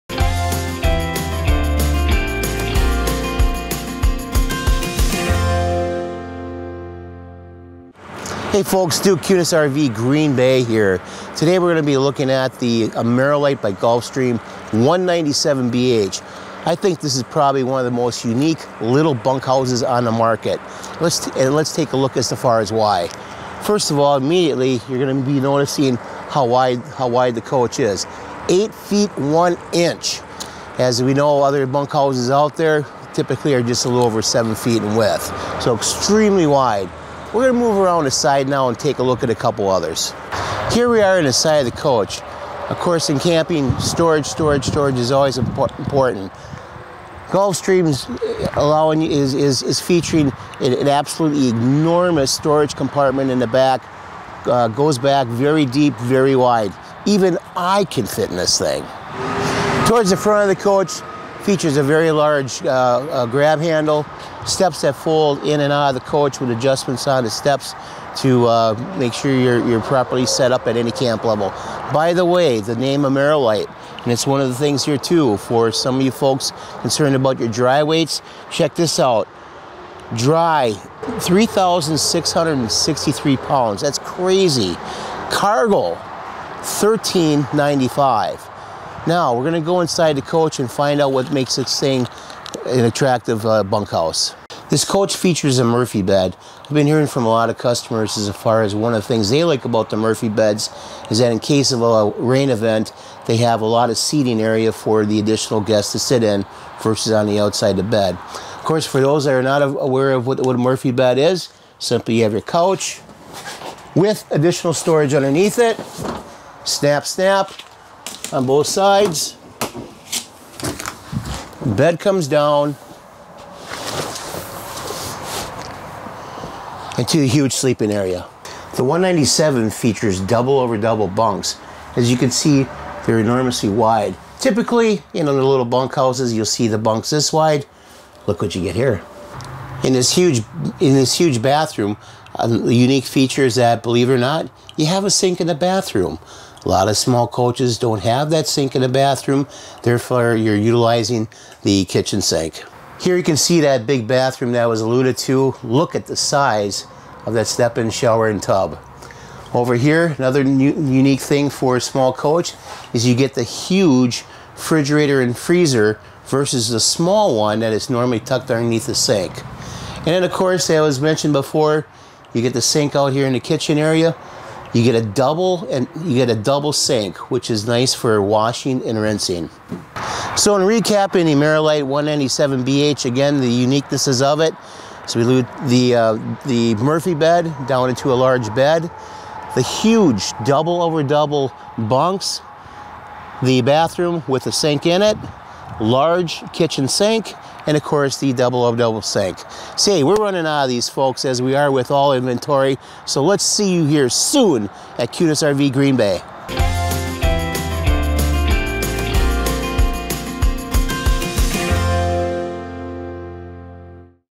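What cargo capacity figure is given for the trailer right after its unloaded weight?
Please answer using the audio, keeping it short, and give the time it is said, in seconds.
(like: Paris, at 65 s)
1395, at 86 s.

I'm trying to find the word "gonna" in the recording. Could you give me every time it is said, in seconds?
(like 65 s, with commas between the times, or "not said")
37 s.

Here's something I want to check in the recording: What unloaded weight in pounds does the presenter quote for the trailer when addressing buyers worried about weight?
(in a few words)
3,663 pounds.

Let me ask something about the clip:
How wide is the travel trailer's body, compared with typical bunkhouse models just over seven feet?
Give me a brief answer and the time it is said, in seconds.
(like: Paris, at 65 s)
8 feet 1 inch, at 28 s.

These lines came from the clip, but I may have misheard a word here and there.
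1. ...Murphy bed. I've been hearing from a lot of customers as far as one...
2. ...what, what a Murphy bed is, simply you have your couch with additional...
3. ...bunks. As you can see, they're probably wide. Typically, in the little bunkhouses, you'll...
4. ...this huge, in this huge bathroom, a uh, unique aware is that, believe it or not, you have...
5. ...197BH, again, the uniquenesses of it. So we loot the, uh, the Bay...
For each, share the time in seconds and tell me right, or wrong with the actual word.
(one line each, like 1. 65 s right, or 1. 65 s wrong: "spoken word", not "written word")
1. 95 s right
2. 110 s right
3. 131 s wrong: "enormously", not "probably"
4. 139 s wrong: "feature", not "aware"
5. 181 s wrong: "Murphy", not "Bay".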